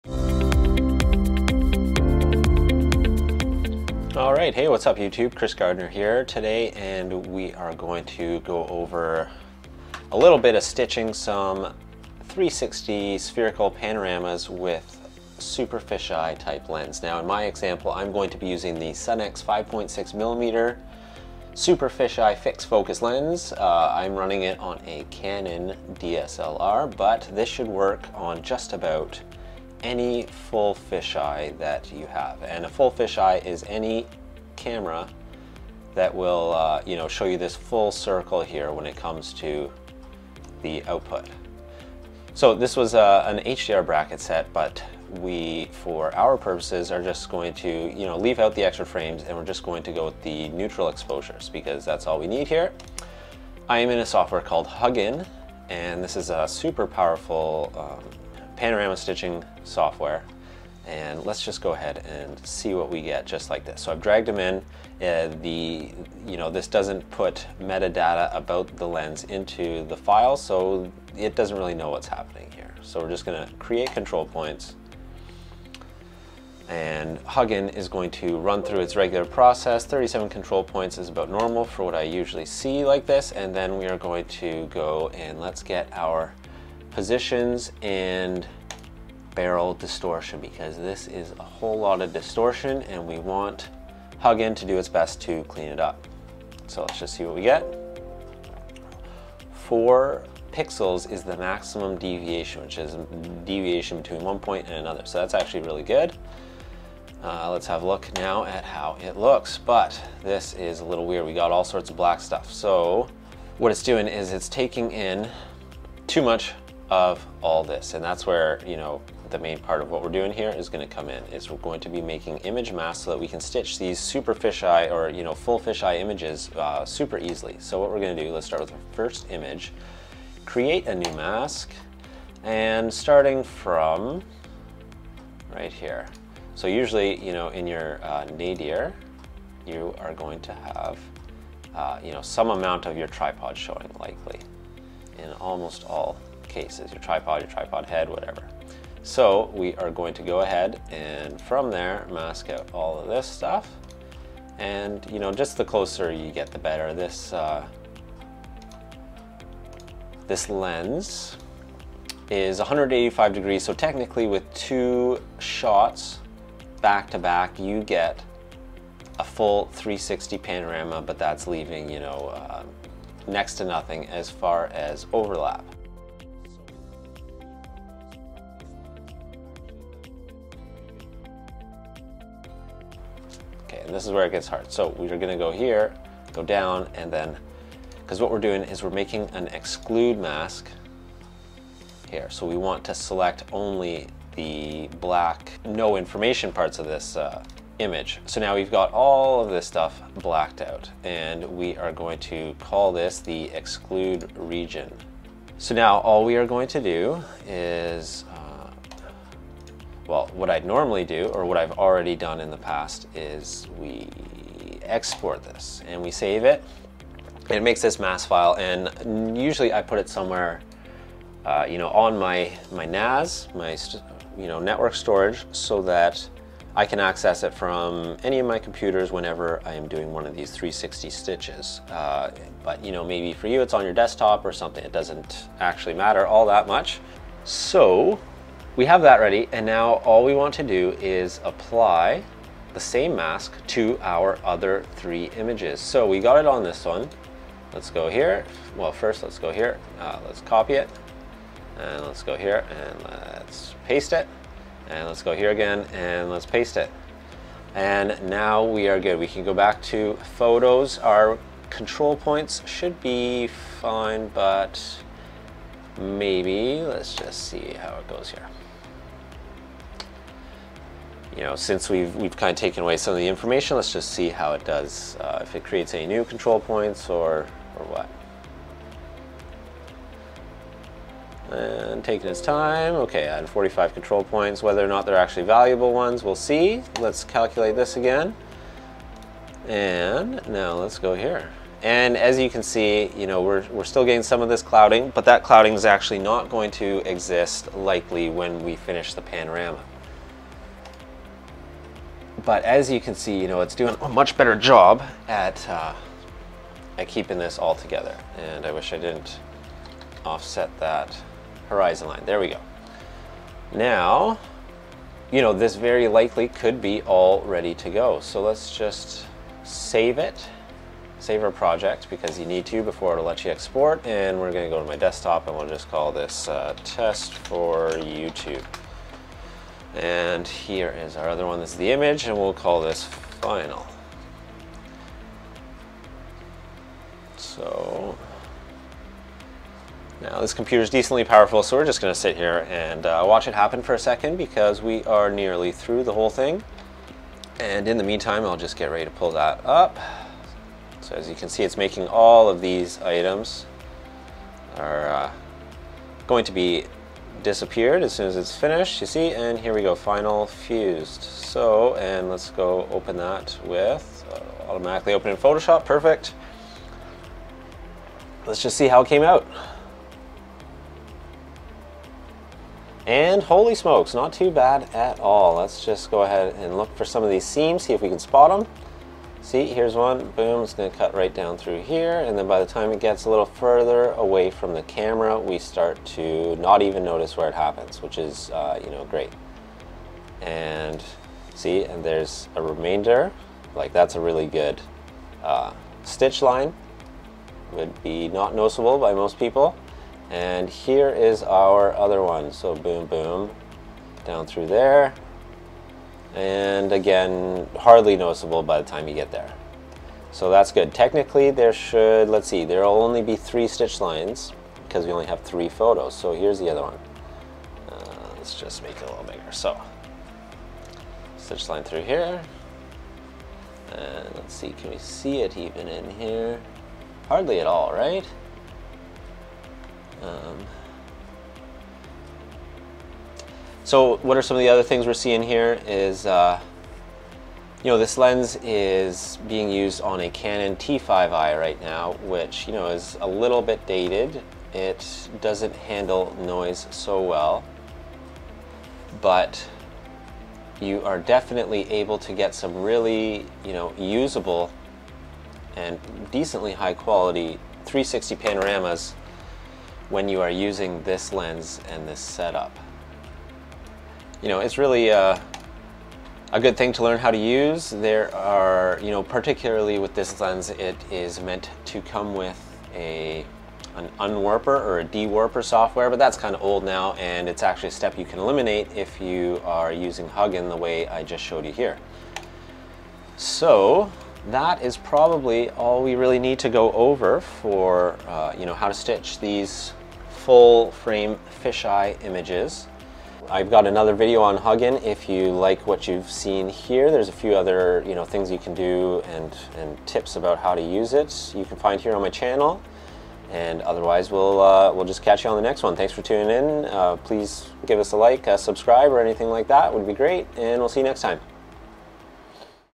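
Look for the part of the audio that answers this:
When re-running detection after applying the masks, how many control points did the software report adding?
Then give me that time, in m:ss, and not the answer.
4:43.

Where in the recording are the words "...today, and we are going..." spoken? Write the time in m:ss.
0:06.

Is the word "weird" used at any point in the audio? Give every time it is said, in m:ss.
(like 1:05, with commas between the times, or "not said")
1:51.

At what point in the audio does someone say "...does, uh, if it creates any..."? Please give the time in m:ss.
4:34.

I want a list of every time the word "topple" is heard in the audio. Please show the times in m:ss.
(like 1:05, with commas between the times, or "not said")
not said.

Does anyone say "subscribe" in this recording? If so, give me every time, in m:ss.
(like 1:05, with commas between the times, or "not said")
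8:28.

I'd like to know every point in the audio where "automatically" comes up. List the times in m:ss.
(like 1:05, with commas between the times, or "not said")
6:04.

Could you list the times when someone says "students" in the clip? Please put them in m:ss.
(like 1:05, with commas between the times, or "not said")
not said.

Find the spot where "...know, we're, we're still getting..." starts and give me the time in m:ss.
4:53.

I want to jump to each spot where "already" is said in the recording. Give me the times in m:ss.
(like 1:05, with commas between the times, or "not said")
3:31.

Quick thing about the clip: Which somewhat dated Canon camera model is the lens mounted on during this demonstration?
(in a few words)
Canon T5i.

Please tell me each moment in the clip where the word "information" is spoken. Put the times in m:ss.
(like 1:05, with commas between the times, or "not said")
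3:15, 4:33.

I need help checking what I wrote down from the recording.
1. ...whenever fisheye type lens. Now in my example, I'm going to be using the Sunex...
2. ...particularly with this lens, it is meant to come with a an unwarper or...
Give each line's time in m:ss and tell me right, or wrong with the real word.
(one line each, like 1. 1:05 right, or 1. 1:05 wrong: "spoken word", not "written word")
1. 0:15 wrong: "super", not "whenever"
2. 7:49 right.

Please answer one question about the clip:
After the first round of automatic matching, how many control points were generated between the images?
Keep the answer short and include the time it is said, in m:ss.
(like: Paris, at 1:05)
37, at 1:19.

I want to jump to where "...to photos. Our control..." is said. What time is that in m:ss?
4:19.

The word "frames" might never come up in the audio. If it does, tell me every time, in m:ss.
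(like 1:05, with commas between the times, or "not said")
0:48, 8:10.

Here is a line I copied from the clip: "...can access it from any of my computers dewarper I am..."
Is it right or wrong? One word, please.
wrong.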